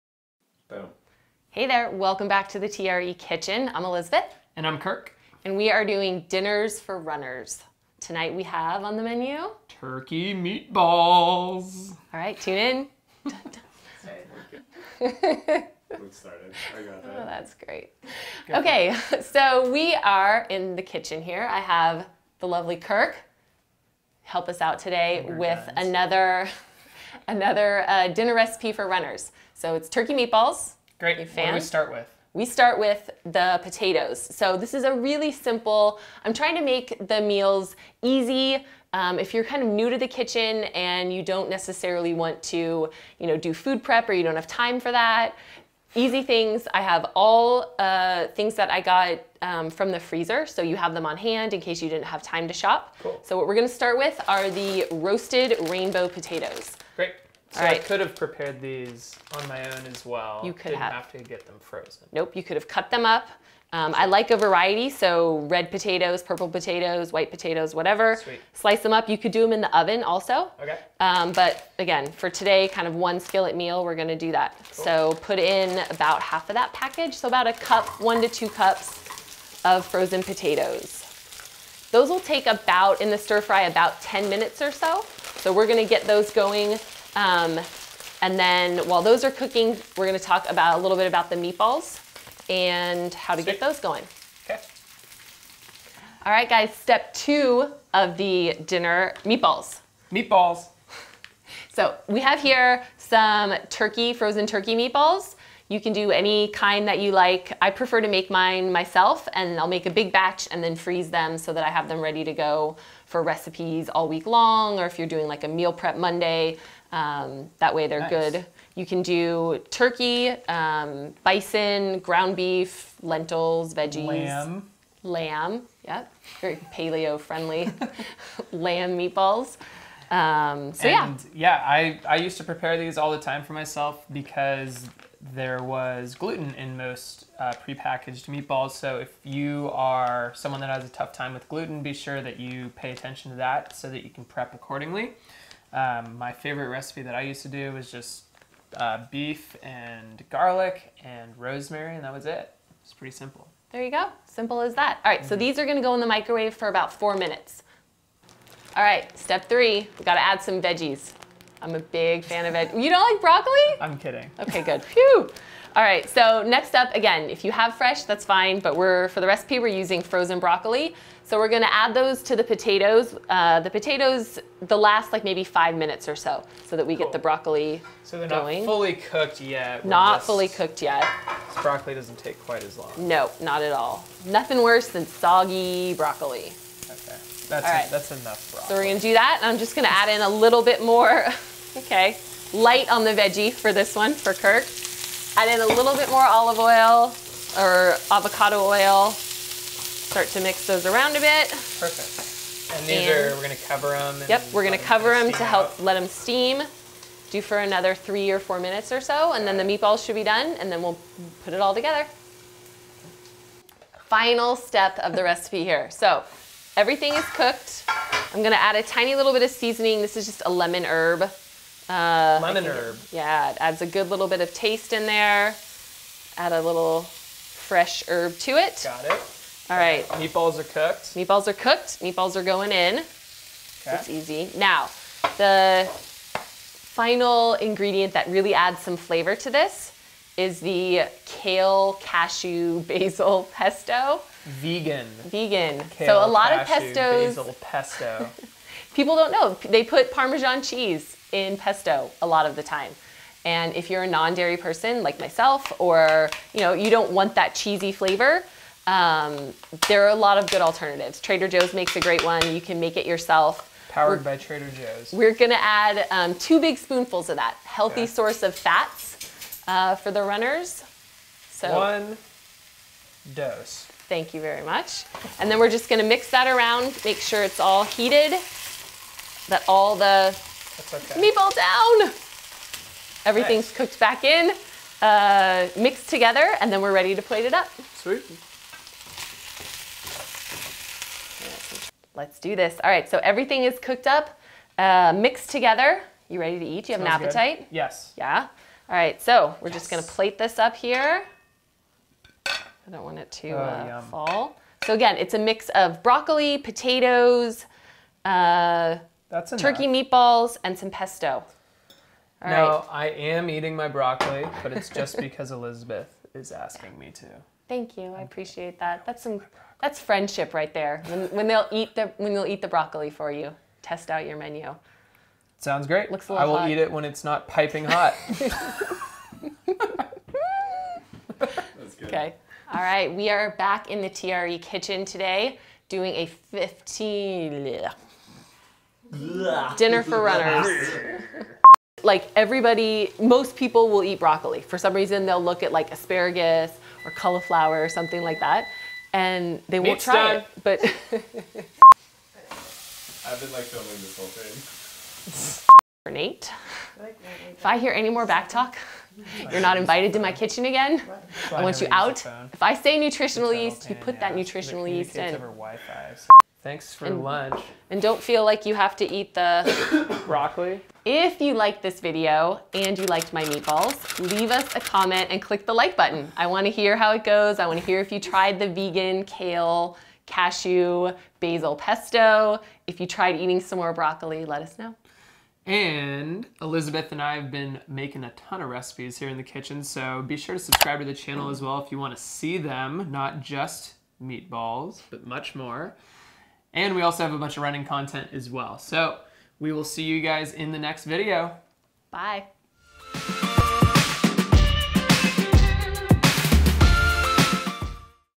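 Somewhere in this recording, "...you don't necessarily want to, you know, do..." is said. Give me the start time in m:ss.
0:41.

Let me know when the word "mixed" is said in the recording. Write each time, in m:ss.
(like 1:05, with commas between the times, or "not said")
4:45, 4:55.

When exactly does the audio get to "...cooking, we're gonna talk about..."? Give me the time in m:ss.
1:29.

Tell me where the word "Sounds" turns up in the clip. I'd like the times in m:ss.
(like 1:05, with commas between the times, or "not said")
4:57, 5:25.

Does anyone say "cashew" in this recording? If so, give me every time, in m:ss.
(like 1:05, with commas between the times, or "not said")
4:01, 4:06, 6:20.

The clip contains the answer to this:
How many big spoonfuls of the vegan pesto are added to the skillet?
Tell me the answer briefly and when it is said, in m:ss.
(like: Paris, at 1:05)
2, at 4:26.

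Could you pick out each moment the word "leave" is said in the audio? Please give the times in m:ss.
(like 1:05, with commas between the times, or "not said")
6:14.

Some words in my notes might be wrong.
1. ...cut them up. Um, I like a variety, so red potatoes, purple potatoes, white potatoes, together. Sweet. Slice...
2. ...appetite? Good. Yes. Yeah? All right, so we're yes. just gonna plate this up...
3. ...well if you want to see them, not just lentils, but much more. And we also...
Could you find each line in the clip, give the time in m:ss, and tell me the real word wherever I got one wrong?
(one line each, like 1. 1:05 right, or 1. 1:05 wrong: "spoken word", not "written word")
1. 1:02 wrong: "whatever", not "together"
2. 4:57 right
3. 6:31 wrong: "meatballs", not "lentils".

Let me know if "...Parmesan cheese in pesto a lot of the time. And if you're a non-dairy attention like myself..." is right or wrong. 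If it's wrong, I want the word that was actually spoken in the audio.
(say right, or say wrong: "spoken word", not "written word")
wrong: "person", not "attention".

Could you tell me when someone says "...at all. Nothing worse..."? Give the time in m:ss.
3:03.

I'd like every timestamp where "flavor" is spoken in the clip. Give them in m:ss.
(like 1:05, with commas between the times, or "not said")
3:58, 4:17.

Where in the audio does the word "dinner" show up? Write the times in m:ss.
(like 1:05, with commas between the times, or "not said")
0:06, 0:28, 1:38, 5:39.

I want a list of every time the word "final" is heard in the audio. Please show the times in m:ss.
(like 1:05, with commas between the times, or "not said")
3:34, 3:56.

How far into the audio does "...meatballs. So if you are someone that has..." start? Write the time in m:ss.
2:18.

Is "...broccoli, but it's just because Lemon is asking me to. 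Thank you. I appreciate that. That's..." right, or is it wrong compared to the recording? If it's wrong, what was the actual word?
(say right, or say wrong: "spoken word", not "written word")
wrong: "Elizabeth", not "Lemon".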